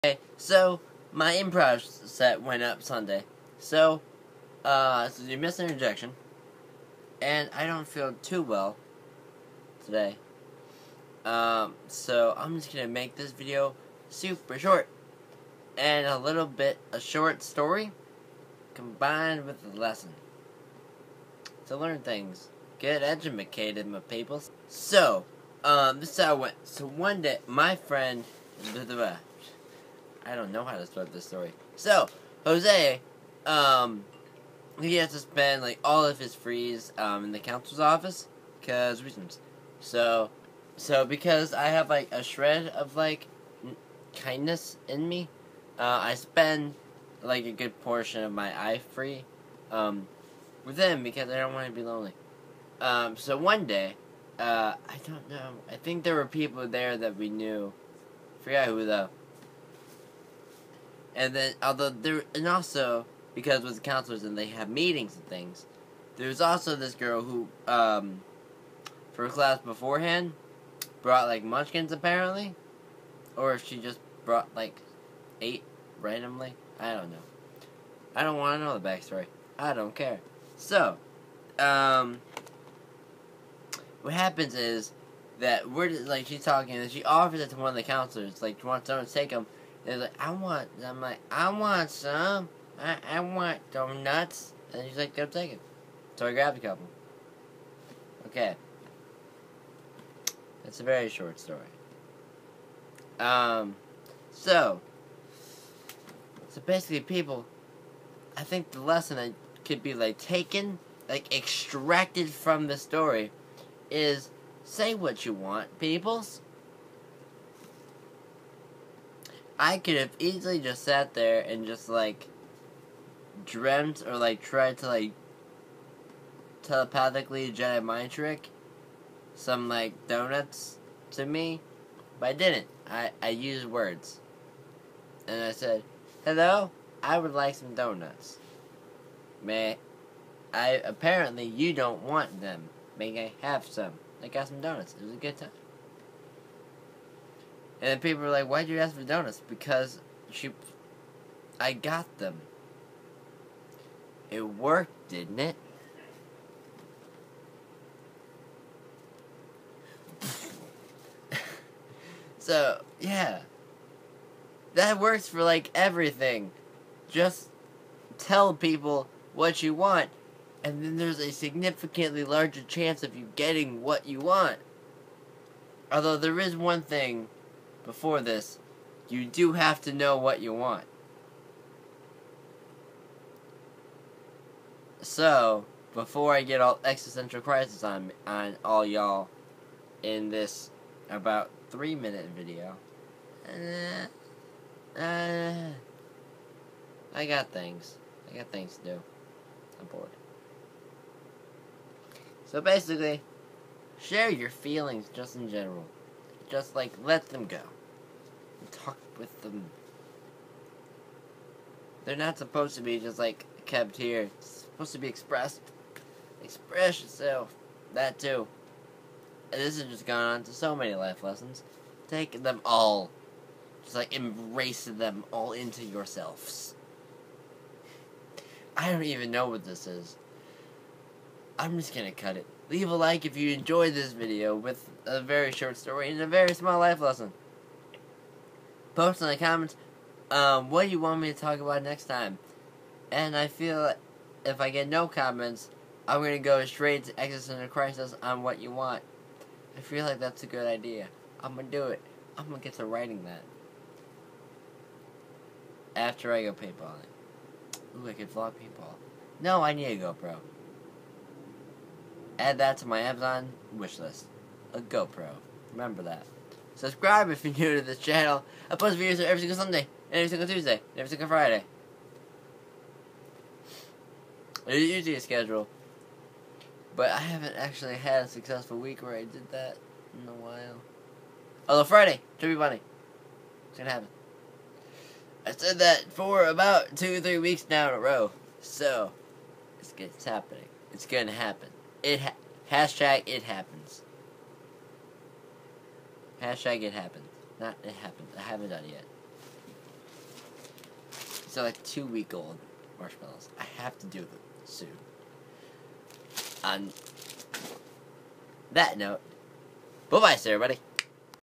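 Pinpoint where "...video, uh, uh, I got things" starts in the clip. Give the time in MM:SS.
03:12.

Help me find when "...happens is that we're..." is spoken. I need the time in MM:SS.
01:24.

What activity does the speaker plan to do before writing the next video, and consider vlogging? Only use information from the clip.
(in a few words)
Paintballing.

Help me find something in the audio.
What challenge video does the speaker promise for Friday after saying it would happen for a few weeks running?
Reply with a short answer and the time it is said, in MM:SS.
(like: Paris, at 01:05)
Chubby Bunny, at 04:42.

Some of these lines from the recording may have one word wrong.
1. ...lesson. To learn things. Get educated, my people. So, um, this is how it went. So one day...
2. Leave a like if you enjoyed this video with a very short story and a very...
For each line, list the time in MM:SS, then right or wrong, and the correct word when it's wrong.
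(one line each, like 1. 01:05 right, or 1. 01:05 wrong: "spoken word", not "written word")
1. 00:19 right
2. 03:52 right.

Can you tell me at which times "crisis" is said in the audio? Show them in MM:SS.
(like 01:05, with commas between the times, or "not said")
03:07, 04:07.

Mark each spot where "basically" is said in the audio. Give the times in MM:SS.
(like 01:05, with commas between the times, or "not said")
01:46, 03:22.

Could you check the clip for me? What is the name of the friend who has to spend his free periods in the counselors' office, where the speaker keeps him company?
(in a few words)
Jose.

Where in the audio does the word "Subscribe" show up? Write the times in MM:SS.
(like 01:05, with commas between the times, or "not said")
04:26.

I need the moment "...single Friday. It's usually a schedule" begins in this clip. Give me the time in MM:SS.
04:31.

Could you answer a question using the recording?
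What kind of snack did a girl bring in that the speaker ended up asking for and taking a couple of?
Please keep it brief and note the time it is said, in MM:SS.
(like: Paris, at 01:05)
Munchkins, at 01:11.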